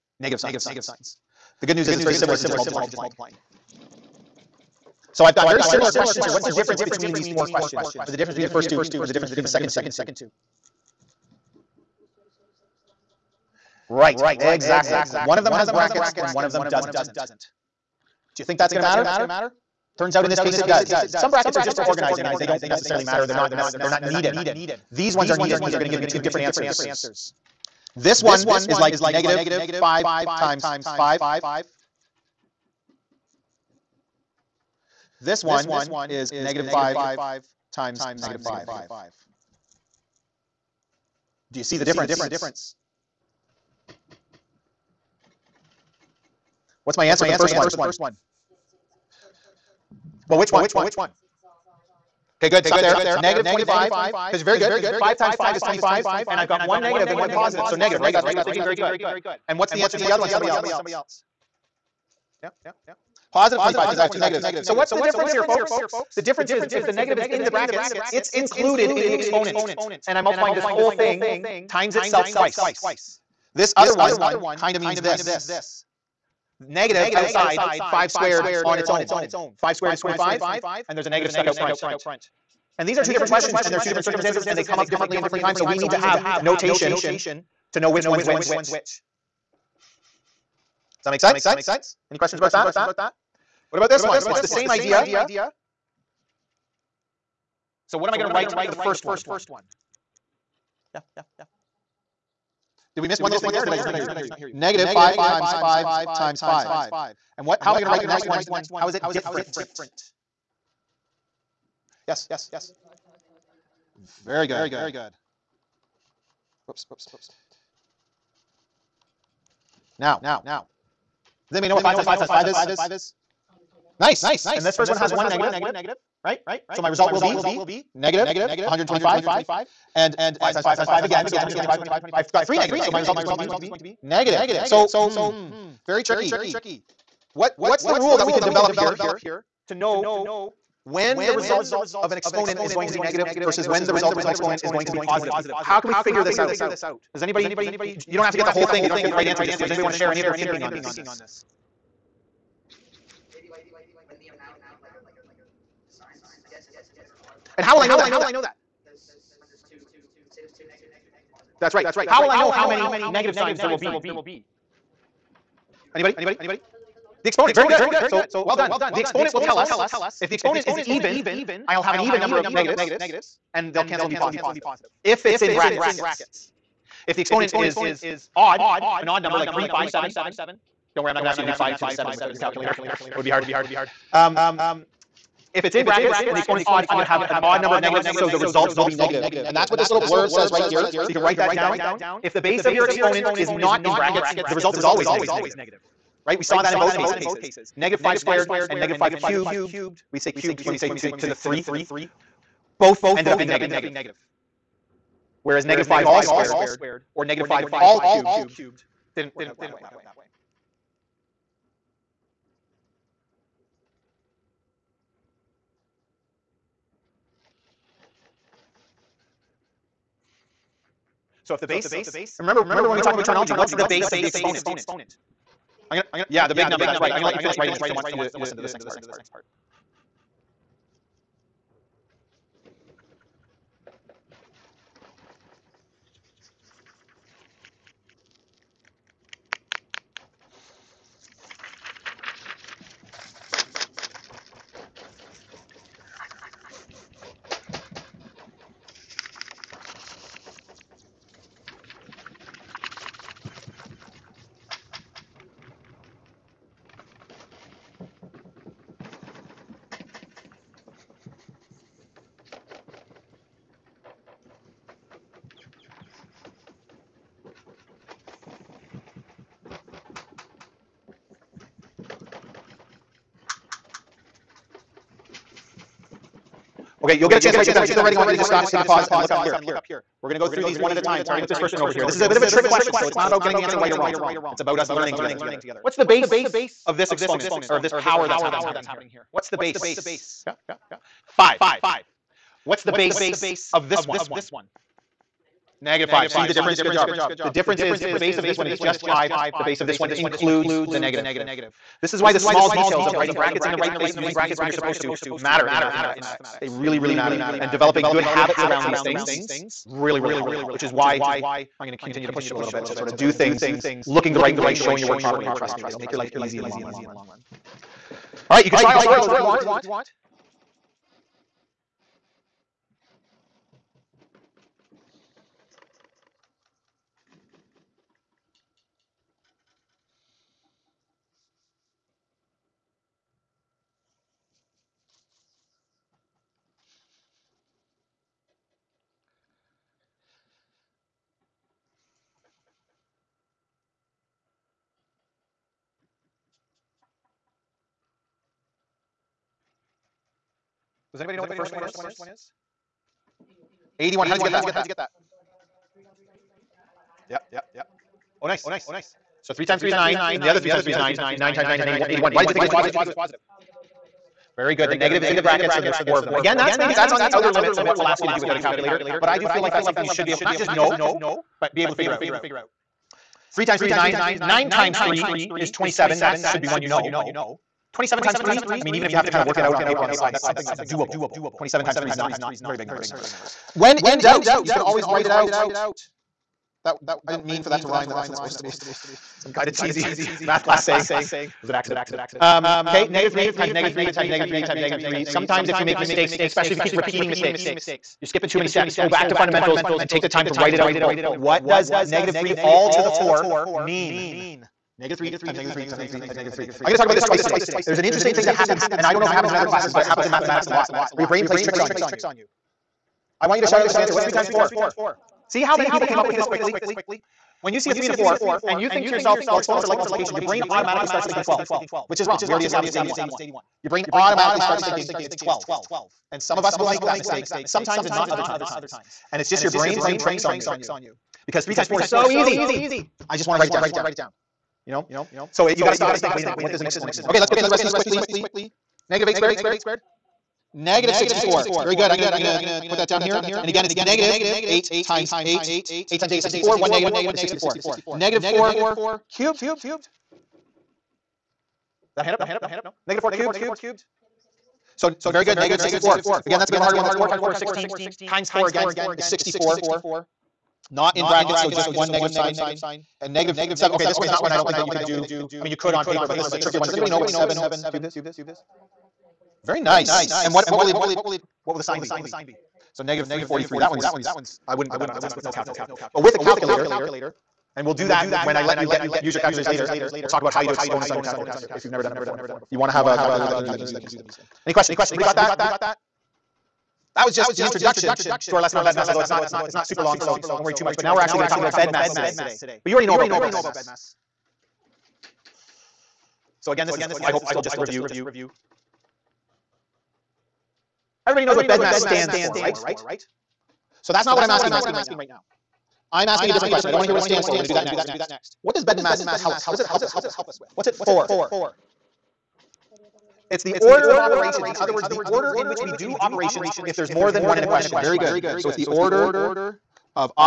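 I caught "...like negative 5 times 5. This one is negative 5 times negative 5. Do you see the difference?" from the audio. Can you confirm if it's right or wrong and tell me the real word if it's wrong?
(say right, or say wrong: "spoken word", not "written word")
right.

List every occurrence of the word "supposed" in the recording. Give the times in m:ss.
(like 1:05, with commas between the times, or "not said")
5:04, 6:28.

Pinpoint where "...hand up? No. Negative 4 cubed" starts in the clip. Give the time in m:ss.
7:32.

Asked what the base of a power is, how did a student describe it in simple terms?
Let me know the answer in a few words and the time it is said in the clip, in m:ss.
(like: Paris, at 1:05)
the big number, at 3:46.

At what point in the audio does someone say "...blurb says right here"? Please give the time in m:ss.
3:10.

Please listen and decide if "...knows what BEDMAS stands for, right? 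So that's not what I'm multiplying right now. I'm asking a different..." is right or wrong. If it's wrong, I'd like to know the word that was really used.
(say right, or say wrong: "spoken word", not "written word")
wrong: "asking", not "multiplying".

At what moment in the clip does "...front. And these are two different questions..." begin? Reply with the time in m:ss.
1:21.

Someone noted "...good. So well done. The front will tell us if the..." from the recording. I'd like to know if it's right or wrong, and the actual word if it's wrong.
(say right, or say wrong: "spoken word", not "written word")
wrong: "exponent", not "front".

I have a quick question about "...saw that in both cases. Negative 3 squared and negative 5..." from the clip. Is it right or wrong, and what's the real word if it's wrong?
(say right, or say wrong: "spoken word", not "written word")
wrong: "5", not "3".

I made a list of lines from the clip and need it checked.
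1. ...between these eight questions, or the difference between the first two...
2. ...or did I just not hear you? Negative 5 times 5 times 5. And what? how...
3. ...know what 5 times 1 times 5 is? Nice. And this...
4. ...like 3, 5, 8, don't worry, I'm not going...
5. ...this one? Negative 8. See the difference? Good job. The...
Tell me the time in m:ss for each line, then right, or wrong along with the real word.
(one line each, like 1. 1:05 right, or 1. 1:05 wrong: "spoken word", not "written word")
1. 0:06 wrong: "four", not "eight"
2. 1:43 right
3. 2:01 wrong: "5", not "1"
4. 2:59 wrong: "7", not "8"
5. 4:53 wrong: "5", not "8".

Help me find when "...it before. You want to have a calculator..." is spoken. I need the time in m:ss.
8:02.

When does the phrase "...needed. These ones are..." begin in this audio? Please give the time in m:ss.
0:24.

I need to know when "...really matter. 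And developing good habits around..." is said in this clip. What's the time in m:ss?
5:06.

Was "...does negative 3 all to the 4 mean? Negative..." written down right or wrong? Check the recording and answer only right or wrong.
right.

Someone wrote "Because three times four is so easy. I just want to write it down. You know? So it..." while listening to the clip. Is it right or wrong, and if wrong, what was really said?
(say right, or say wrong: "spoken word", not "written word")
right.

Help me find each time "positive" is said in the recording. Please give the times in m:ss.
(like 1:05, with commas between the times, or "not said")
0:57, 1:03, 2:24, 2:54, 6:02.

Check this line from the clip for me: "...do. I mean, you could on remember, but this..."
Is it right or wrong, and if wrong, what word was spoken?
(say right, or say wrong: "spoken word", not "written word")
wrong: "paper", not "remember".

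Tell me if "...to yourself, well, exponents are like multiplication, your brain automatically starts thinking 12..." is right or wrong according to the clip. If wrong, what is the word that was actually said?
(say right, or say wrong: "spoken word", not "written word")
right.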